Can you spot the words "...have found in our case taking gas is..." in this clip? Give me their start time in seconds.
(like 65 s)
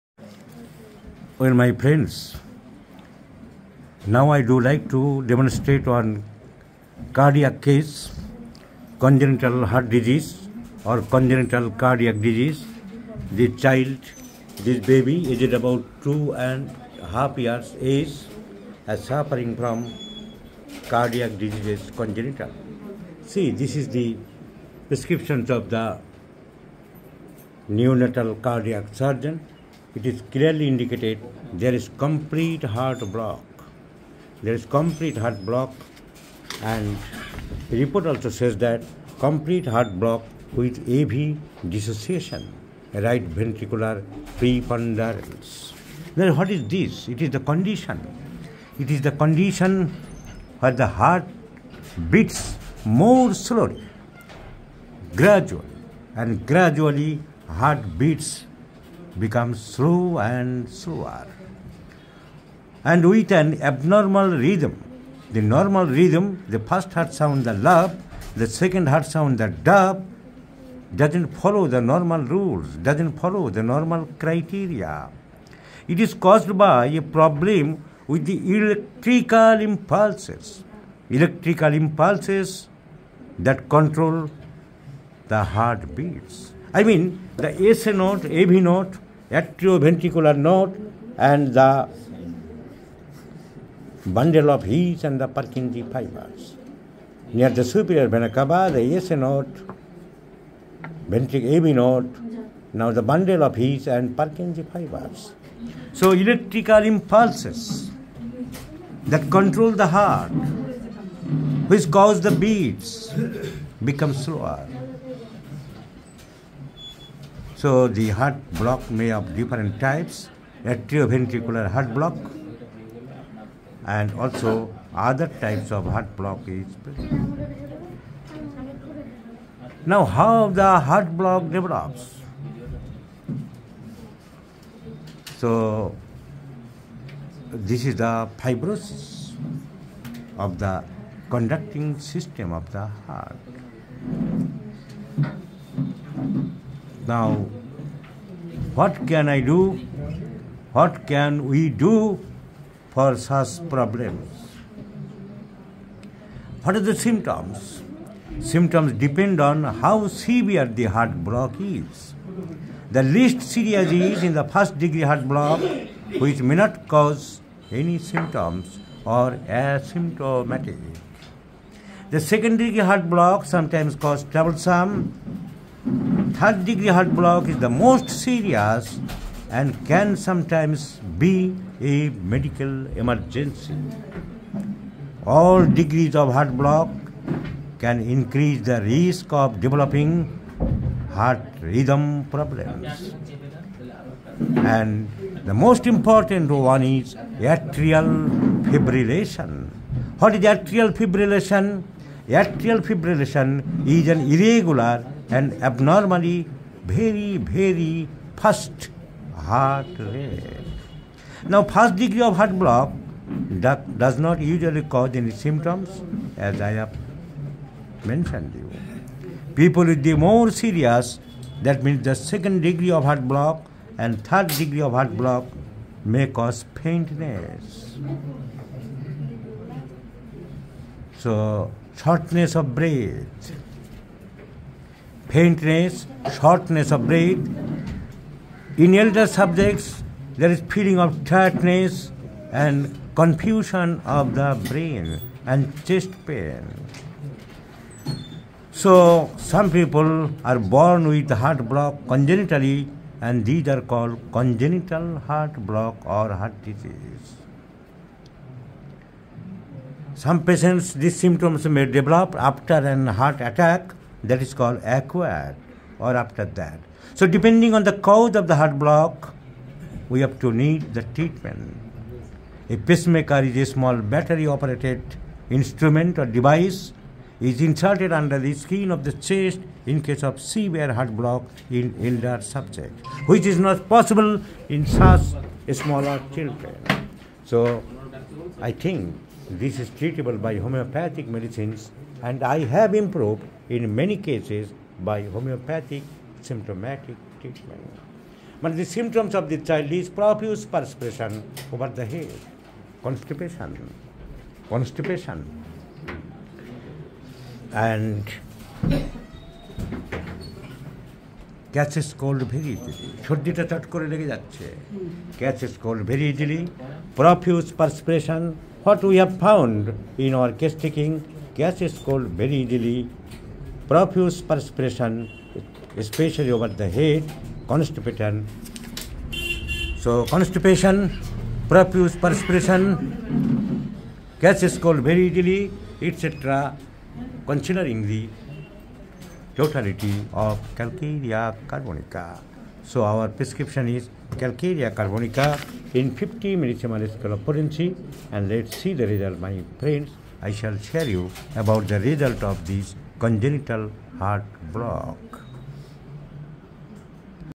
319 s.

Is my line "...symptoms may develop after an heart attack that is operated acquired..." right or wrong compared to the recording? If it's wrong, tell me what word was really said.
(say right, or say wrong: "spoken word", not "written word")
wrong: "called", not "operated".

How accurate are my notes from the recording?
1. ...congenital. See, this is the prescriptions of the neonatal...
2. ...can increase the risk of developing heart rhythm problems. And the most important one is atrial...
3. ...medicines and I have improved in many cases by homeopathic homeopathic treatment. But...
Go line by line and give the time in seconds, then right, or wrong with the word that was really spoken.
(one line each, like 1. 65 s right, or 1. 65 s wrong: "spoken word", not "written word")
1. 21 s right
2. 187 s right
3. 291 s wrong: "symptomatic", not "homeopathic".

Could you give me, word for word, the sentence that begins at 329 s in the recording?
So constipation, profuse perspiration, gas is cooled very easily, etc.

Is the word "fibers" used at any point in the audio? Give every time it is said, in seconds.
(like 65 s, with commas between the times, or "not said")
95 s, 104 s.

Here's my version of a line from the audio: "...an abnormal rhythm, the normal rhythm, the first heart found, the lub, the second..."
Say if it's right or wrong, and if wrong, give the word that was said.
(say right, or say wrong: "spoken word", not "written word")
wrong: "sound", not "found".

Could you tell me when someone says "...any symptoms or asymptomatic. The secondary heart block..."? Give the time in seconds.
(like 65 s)
167 s.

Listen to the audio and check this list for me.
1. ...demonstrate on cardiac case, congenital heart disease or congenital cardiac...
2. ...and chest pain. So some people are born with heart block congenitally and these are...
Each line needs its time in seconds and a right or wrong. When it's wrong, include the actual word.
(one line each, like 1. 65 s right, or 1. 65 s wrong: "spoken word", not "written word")
1. 5 s right
2. 245 s right.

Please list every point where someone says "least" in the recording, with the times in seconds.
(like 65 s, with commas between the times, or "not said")
163 s.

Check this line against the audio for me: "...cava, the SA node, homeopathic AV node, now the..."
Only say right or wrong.
wrong.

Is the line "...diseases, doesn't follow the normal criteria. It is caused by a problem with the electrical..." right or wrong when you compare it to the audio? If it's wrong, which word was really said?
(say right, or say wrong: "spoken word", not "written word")
wrong: "rules", not "diseases".